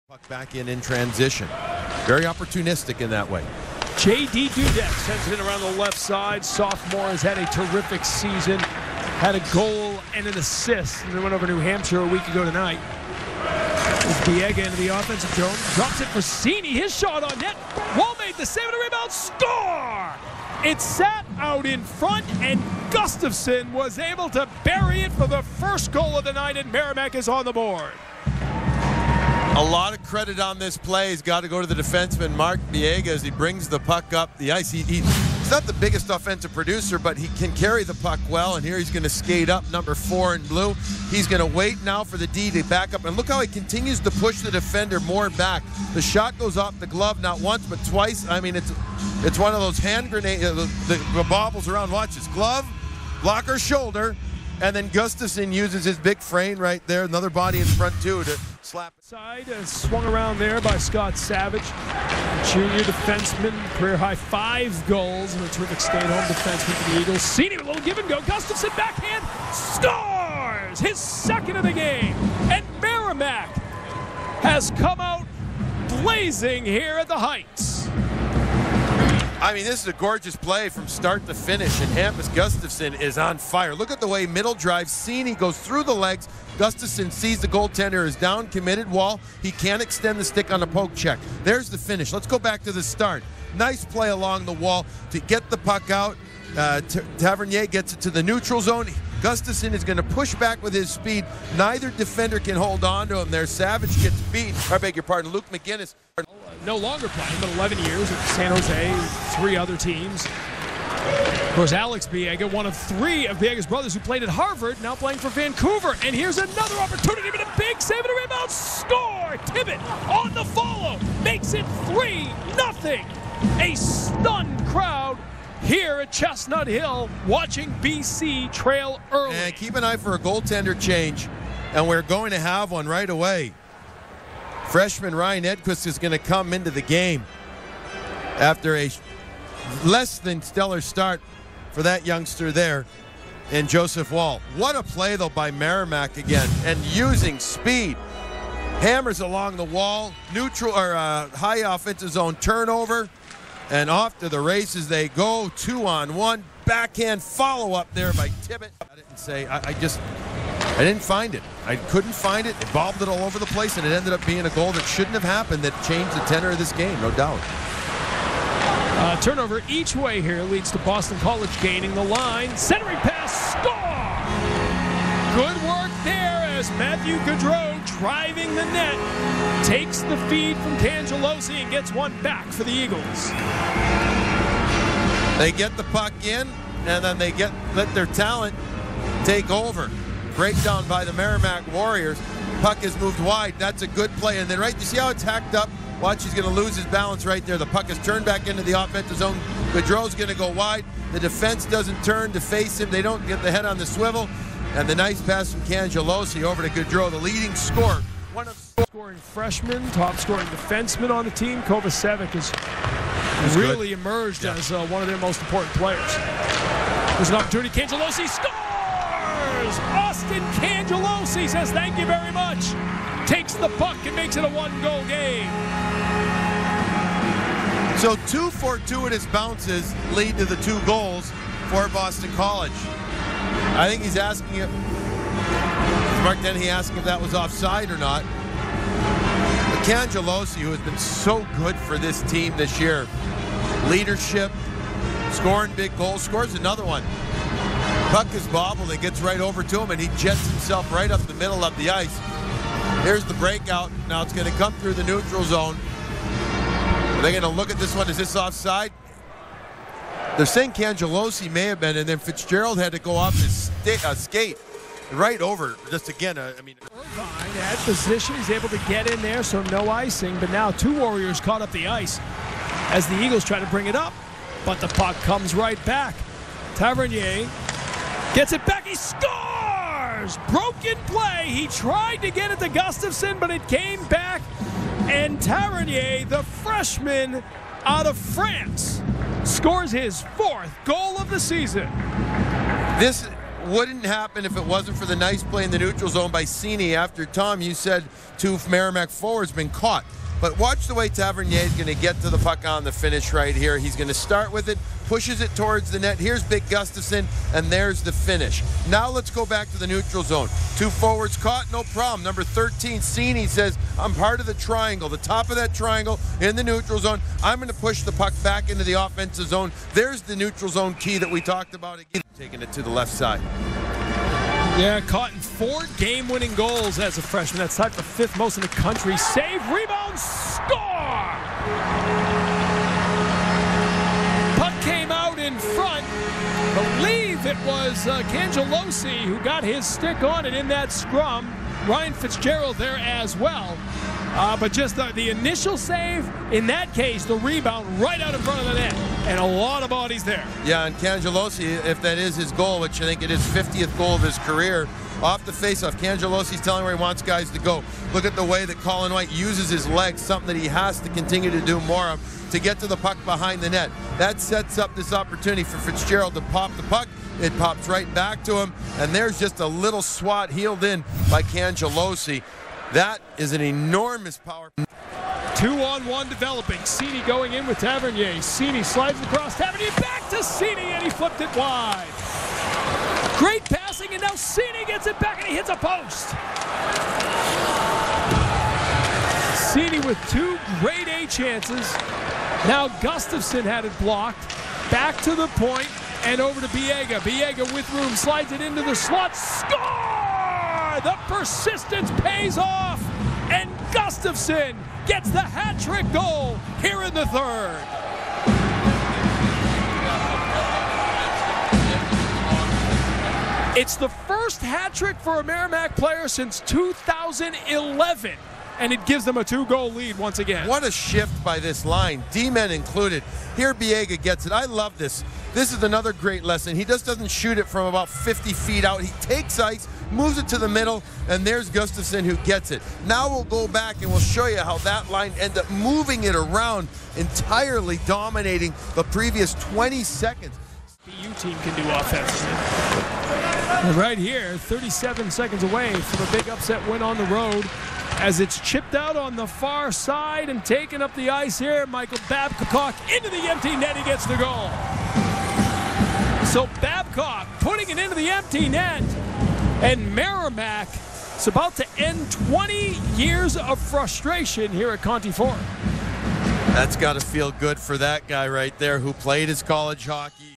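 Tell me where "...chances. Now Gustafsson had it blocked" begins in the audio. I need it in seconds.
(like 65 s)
391 s.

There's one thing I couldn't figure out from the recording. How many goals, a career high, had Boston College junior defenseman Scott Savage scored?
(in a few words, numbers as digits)
5.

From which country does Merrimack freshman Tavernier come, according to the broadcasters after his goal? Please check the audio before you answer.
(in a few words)
France.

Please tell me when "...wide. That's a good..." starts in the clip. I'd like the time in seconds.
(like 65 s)
193 s.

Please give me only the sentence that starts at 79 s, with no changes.
I mean, this is a gorgeous play from start to finish, and Hampus Gustafsson is on fire.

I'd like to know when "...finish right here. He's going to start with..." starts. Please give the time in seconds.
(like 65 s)
302 s.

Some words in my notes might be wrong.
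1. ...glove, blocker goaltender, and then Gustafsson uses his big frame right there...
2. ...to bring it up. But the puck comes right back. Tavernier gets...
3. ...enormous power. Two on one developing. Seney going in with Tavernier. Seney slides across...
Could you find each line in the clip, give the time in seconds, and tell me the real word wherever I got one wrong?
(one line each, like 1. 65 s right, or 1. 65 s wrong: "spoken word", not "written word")
1. 52 s wrong: "shoulder", not "goaltender"
2. 273 s right
3. 373 s right.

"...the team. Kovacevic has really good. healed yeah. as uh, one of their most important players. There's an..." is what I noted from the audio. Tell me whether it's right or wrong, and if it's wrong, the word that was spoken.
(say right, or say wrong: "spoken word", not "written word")
wrong: "emerged", not "healed".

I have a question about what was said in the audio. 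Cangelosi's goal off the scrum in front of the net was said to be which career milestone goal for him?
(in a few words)
50th.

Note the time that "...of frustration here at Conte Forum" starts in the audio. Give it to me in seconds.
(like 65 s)
463 s.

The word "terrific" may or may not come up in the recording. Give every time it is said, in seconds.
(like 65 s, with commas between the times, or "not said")
7 s, 65 s.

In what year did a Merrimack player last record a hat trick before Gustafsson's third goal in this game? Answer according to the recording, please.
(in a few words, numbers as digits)
2011.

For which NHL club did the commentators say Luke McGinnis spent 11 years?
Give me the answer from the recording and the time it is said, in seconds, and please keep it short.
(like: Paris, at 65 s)
San Jose, at 108 s.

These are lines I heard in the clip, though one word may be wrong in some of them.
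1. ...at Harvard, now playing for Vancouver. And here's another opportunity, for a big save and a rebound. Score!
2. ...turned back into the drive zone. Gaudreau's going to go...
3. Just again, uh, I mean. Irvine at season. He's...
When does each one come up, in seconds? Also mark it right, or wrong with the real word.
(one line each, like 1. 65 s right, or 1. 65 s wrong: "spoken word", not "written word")
1. 114 s right
2. 197 s wrong: "offensive", not "drive"
3. 265 s wrong: "position", not "season".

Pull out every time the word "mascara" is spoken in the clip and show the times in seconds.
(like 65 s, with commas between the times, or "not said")
not said.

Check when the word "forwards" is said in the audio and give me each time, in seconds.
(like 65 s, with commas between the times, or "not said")
299 s, 310 s.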